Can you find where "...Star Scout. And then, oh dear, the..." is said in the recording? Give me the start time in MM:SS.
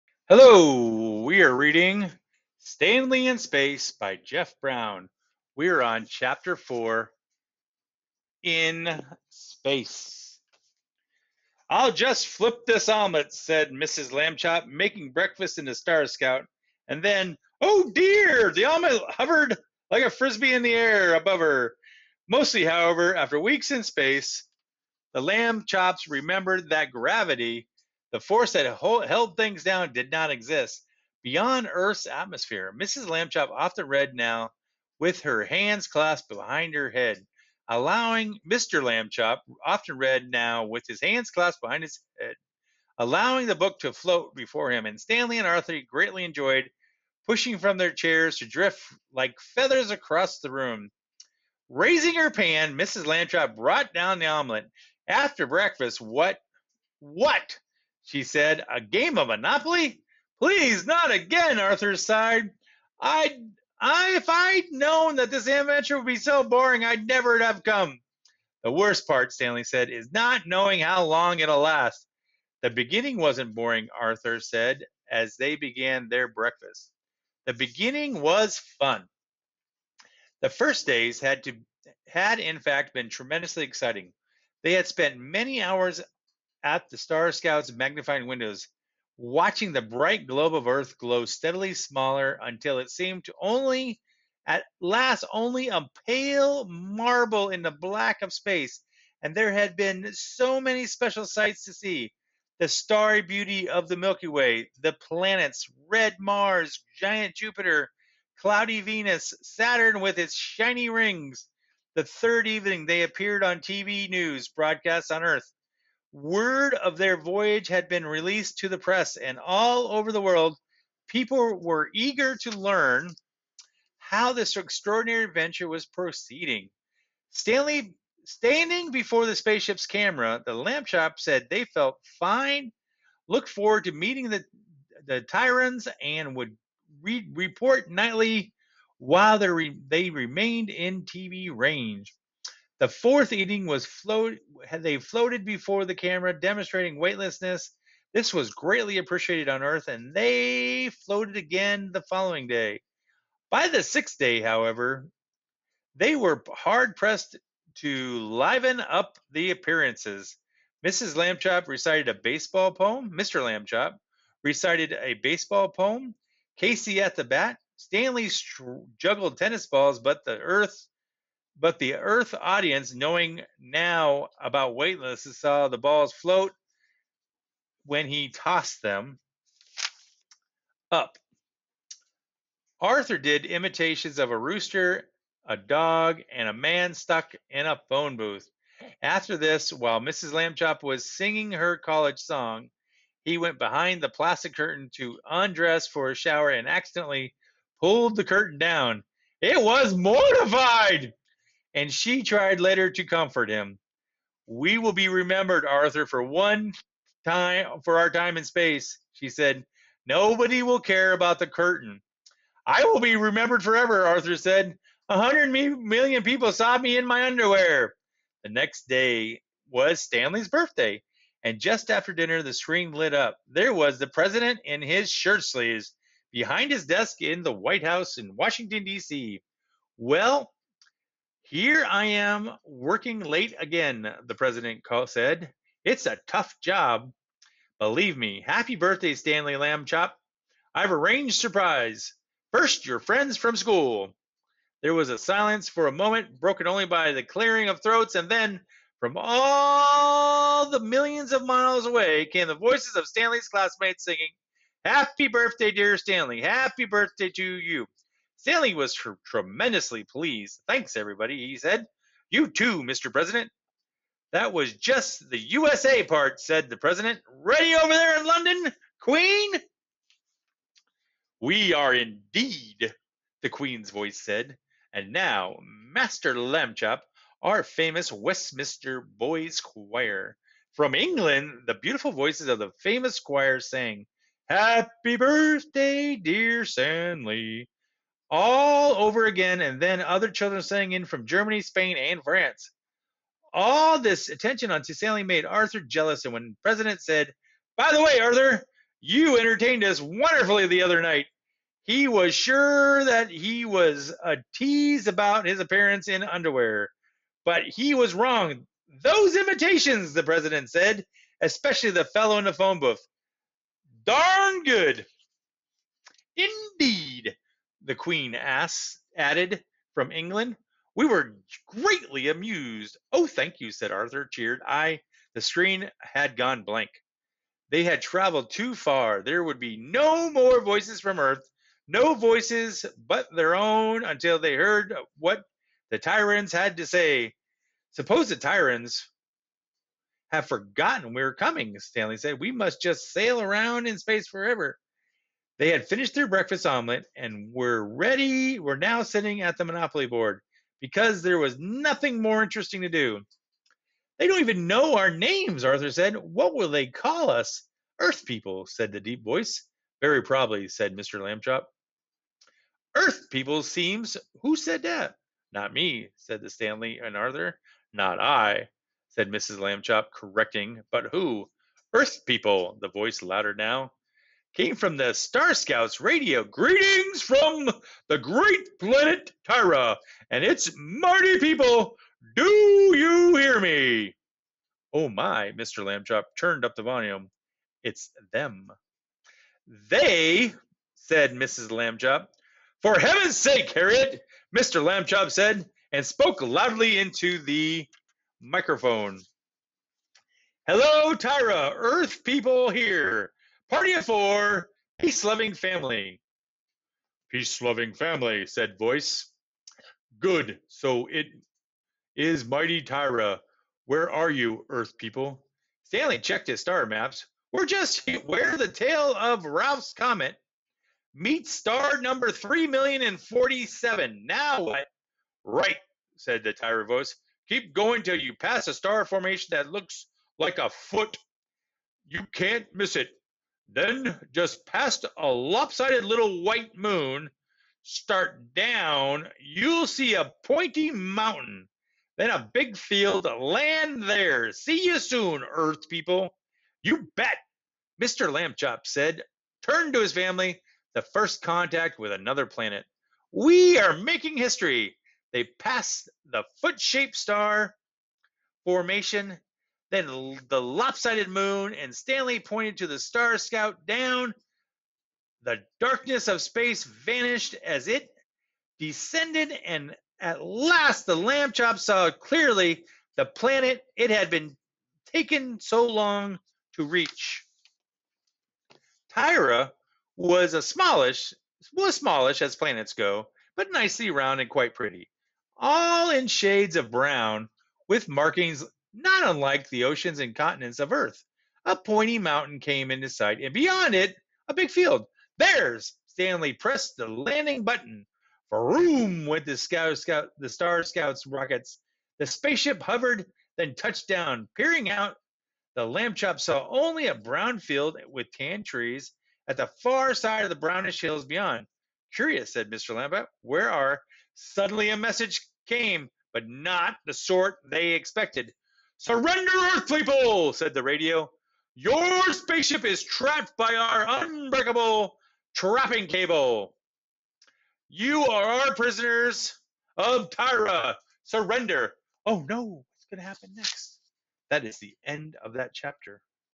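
00:15.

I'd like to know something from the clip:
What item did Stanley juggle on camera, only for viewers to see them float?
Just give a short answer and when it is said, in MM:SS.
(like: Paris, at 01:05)
Tennis balls, at 02:49.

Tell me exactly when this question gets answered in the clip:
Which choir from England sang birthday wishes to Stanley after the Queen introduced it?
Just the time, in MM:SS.
04:38.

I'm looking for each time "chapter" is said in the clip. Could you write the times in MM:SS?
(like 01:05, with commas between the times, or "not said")
00:06, 08:55.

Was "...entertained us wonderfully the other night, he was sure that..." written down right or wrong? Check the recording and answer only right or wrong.
right.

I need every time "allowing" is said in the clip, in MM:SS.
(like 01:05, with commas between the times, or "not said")
00:37, 00:42.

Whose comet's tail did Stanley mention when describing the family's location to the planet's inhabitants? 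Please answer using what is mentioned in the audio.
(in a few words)
Ralph's.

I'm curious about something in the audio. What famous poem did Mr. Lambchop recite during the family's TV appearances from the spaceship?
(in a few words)
Casey at the Bat.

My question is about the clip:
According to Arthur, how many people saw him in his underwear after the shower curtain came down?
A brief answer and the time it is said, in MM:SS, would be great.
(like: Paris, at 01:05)
100 million, at 03:35.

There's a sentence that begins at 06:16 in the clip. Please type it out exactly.
Greetings from the great planet Tyrra, and it's Marty people.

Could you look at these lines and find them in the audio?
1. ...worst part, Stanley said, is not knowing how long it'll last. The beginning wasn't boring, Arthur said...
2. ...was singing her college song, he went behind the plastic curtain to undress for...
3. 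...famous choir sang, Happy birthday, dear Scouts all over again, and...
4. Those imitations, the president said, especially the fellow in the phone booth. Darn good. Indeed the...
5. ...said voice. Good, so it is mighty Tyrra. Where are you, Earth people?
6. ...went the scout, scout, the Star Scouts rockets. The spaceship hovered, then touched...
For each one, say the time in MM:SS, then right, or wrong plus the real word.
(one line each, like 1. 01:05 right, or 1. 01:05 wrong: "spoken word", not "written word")
1. 01:08 right
2. 03:10 right
3. 04:42 wrong: "Stanley", not "Scouts"
4. 05:09 right
5. 06:48 right
6. 08:19 right.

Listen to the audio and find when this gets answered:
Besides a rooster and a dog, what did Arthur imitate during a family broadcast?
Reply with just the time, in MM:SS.
03:06.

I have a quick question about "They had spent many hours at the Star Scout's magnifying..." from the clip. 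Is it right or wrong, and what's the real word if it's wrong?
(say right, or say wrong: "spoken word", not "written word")
right.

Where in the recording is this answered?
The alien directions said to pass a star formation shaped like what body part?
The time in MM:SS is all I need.
07:10.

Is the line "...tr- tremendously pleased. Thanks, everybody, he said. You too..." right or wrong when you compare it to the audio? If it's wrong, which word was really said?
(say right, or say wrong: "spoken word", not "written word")
right.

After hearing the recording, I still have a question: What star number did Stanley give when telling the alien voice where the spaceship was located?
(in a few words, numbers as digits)
3,047.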